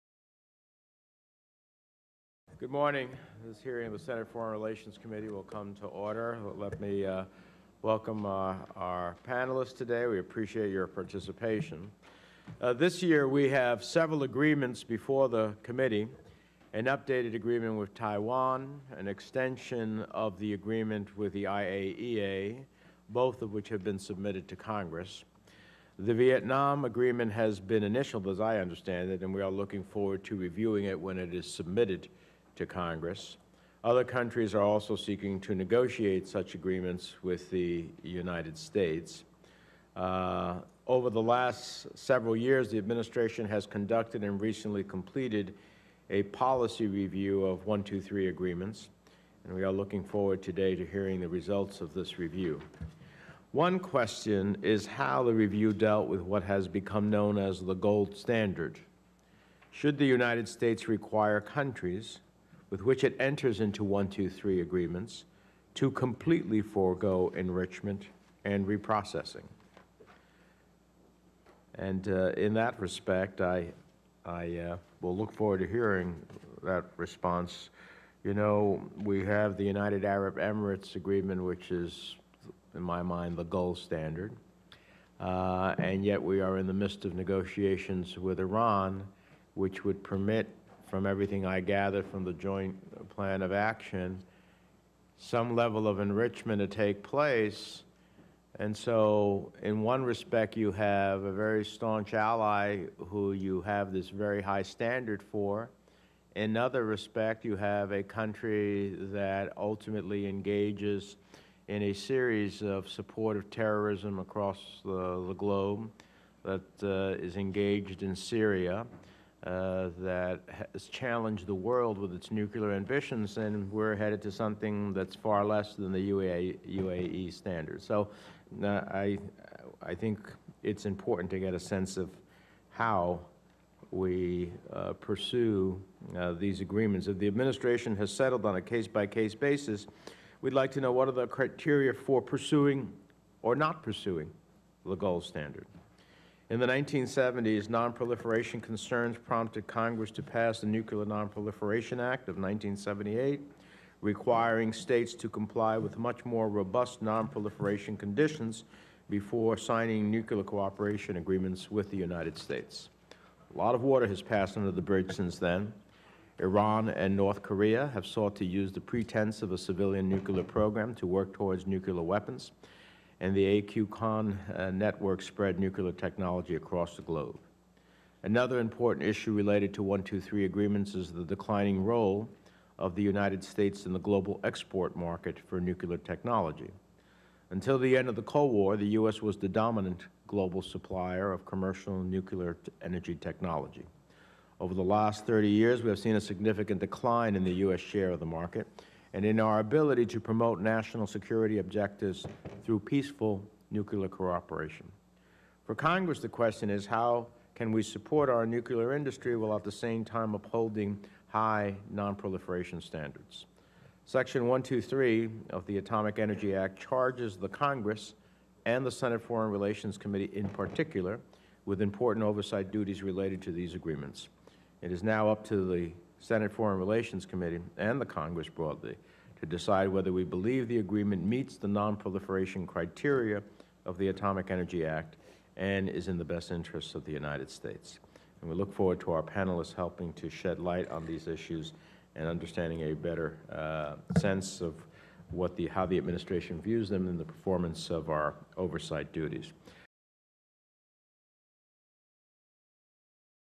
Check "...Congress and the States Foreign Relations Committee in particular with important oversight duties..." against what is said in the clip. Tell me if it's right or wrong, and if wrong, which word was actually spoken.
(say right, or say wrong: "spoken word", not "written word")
wrong: "Senate", not "States".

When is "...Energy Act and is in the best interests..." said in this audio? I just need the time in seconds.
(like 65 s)
234 s.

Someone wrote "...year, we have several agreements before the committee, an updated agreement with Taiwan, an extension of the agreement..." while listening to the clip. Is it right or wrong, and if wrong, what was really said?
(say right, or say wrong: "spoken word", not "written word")
right.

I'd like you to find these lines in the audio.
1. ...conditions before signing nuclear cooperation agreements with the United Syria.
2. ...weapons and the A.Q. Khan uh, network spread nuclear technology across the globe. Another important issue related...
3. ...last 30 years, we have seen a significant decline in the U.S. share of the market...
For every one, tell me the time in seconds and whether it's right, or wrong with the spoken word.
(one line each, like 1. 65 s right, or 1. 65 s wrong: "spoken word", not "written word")
1. 157 s wrong: "States", not "Syria"
2. 172 s right
3. 194 s right.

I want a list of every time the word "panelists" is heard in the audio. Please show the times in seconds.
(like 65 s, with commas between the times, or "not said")
9 s, 239 s.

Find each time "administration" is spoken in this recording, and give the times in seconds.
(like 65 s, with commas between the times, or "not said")
42 s, 137 s, 245 s.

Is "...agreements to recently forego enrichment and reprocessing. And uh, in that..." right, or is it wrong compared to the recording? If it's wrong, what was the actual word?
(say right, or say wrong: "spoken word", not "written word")
wrong: "completely", not "recently".